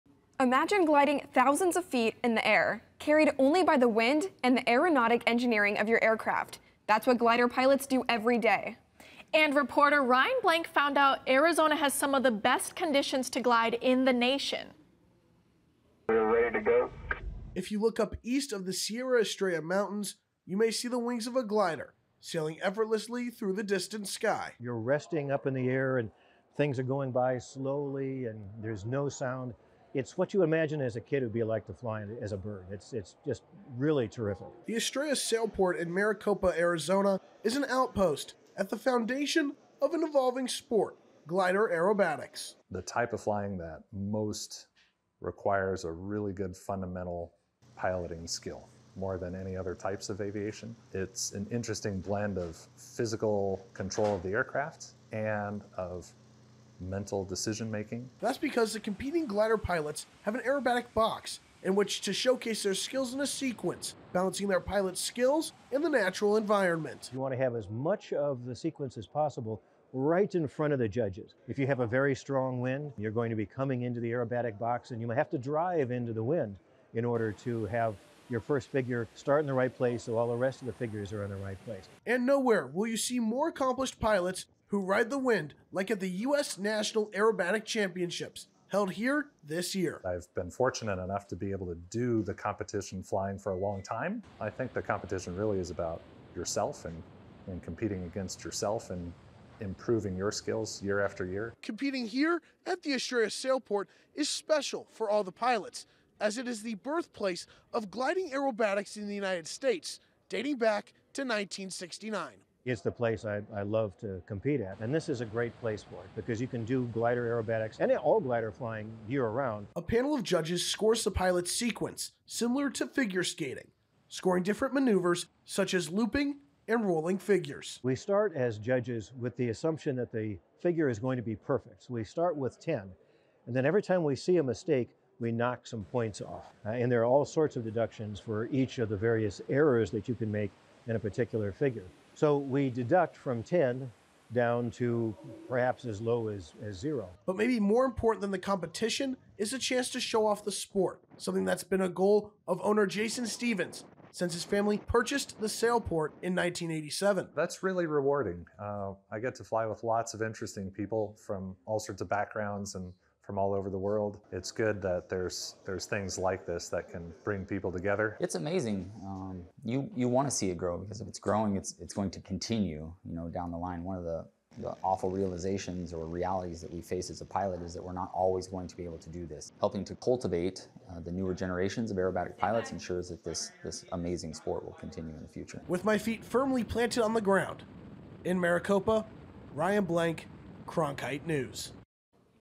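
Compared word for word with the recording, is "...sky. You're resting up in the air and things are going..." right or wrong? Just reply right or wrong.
right.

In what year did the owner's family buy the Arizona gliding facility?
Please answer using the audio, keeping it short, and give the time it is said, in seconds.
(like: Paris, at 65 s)
1987, at 156 s.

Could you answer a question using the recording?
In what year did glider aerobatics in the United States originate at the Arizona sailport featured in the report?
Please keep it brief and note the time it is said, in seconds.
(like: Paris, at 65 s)
1969, at 111 s.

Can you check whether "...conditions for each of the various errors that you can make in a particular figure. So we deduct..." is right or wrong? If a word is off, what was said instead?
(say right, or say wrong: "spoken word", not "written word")
wrong: "deductions", not "conditions".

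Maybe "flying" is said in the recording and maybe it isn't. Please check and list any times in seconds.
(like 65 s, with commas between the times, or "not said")
43 s, 93 s, 118 s.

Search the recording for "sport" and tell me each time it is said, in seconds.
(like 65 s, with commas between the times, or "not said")
40 s, 150 s, 184 s.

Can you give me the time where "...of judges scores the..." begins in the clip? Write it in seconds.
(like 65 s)
120 s.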